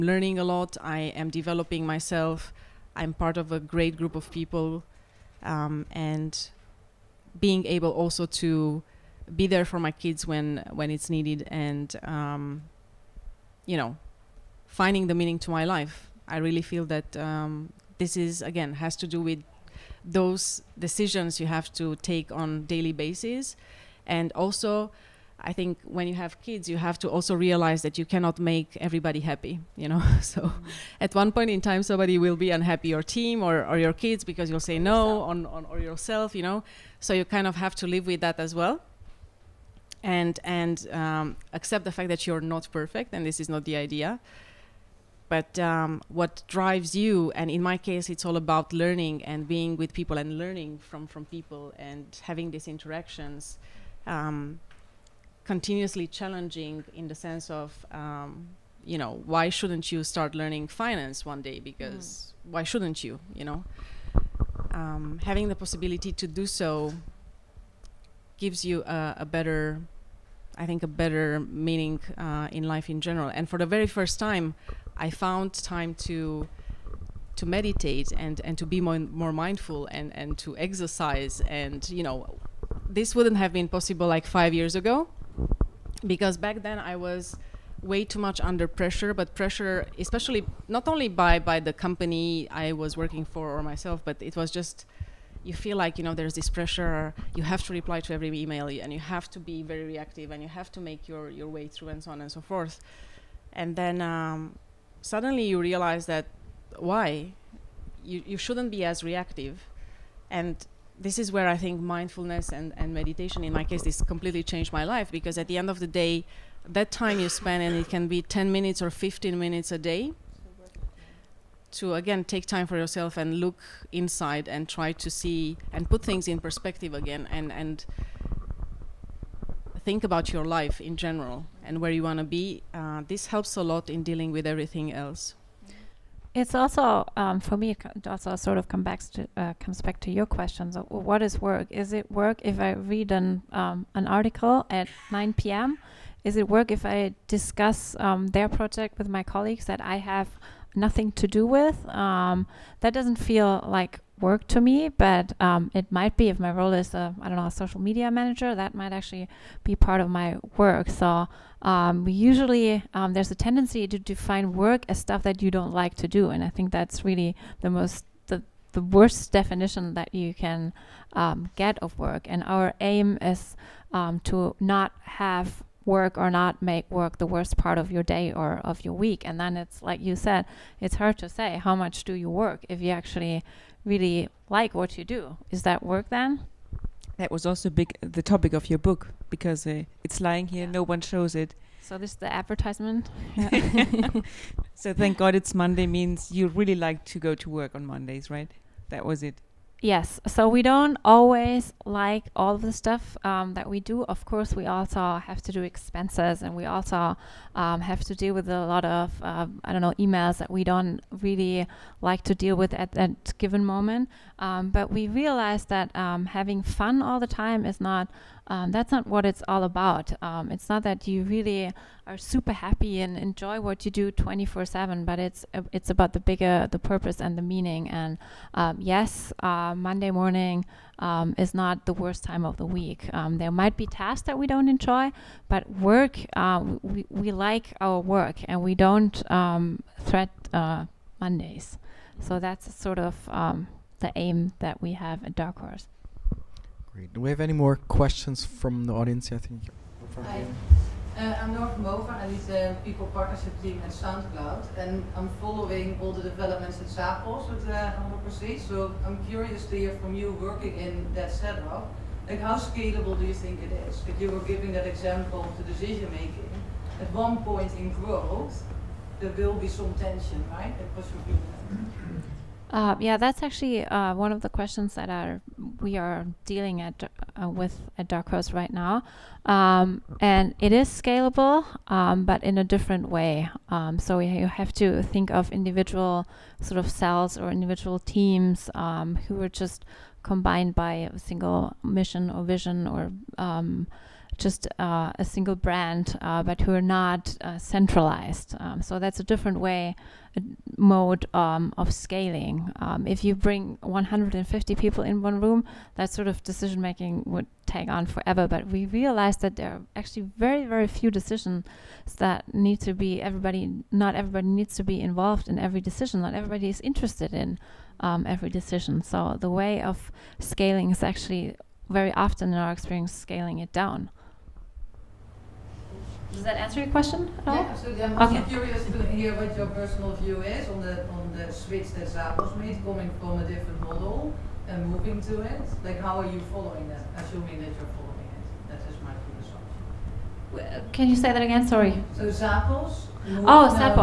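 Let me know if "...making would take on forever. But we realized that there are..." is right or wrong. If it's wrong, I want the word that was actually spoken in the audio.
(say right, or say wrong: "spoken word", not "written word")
right.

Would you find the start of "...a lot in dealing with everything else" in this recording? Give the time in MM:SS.
02:13.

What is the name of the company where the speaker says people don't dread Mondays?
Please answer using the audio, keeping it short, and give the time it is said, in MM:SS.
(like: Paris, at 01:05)
Dark Horse, at 04:05.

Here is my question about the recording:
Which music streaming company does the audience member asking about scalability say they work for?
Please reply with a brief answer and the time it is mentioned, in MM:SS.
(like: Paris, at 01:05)
SoundCloud, at 04:13.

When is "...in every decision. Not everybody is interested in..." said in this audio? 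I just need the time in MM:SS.
05:15.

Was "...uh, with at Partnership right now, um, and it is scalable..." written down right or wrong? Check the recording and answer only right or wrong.
wrong.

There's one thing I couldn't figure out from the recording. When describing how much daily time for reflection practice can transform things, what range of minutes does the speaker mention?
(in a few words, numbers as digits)
10 or 15 minutes.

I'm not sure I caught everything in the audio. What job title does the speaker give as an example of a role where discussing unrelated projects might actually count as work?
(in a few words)
social media manager.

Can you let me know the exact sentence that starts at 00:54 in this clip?
Um, continuously challenging in the sense of um, you know why shouldn't you start learning finance one day because mm.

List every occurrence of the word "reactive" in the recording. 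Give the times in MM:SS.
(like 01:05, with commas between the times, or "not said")
01:39, 01:49.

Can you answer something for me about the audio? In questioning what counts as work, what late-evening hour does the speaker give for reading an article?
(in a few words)
9 p.m.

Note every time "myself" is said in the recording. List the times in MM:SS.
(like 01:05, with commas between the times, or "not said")
00:01, 01:33.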